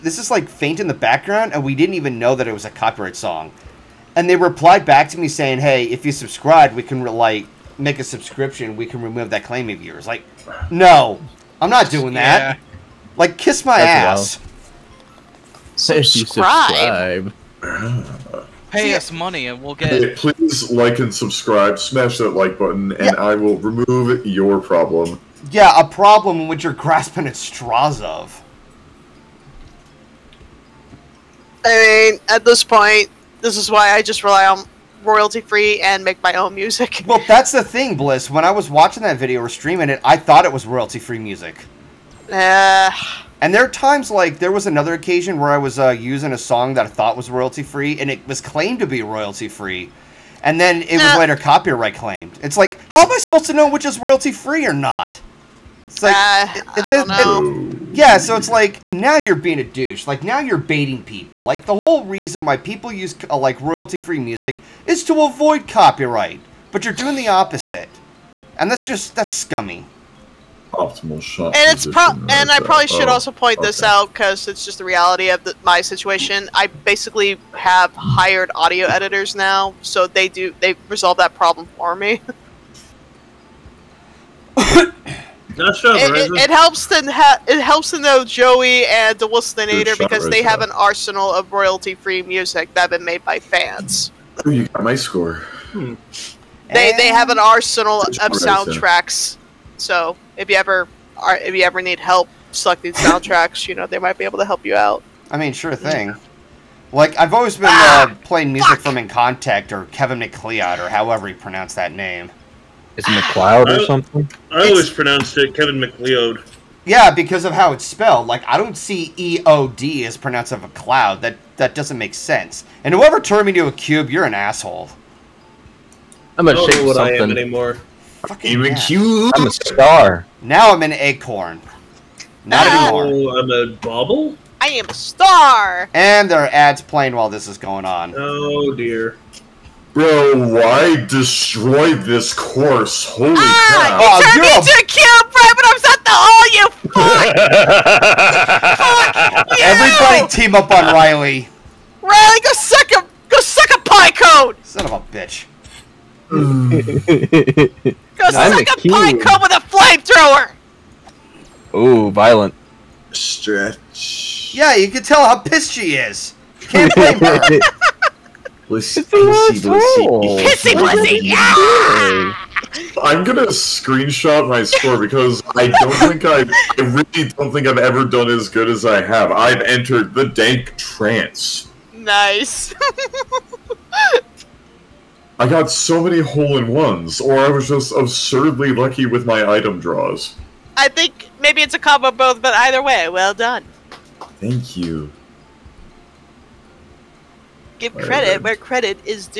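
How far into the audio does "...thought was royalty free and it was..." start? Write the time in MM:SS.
00:46.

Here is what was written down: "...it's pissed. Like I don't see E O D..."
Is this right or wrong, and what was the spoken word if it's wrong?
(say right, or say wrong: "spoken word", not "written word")
wrong: "spelled", not "pissed".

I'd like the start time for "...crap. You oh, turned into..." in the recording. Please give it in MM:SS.
02:23.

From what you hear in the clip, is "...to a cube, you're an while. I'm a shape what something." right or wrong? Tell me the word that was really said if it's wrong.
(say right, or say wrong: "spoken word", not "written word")
wrong: "asshole", not "while".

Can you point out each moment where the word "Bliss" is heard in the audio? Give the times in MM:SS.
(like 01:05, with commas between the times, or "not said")
00:37.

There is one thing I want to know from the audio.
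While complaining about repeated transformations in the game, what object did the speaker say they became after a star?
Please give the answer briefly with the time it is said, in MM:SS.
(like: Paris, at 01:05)
acorn, at 02:10.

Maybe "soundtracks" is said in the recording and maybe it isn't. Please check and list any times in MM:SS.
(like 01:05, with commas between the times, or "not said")
01:38, 01:42.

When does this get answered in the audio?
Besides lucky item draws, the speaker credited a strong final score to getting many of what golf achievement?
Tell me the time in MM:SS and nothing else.
03:06.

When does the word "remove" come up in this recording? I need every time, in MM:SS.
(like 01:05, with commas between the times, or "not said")
00:09, 00:23.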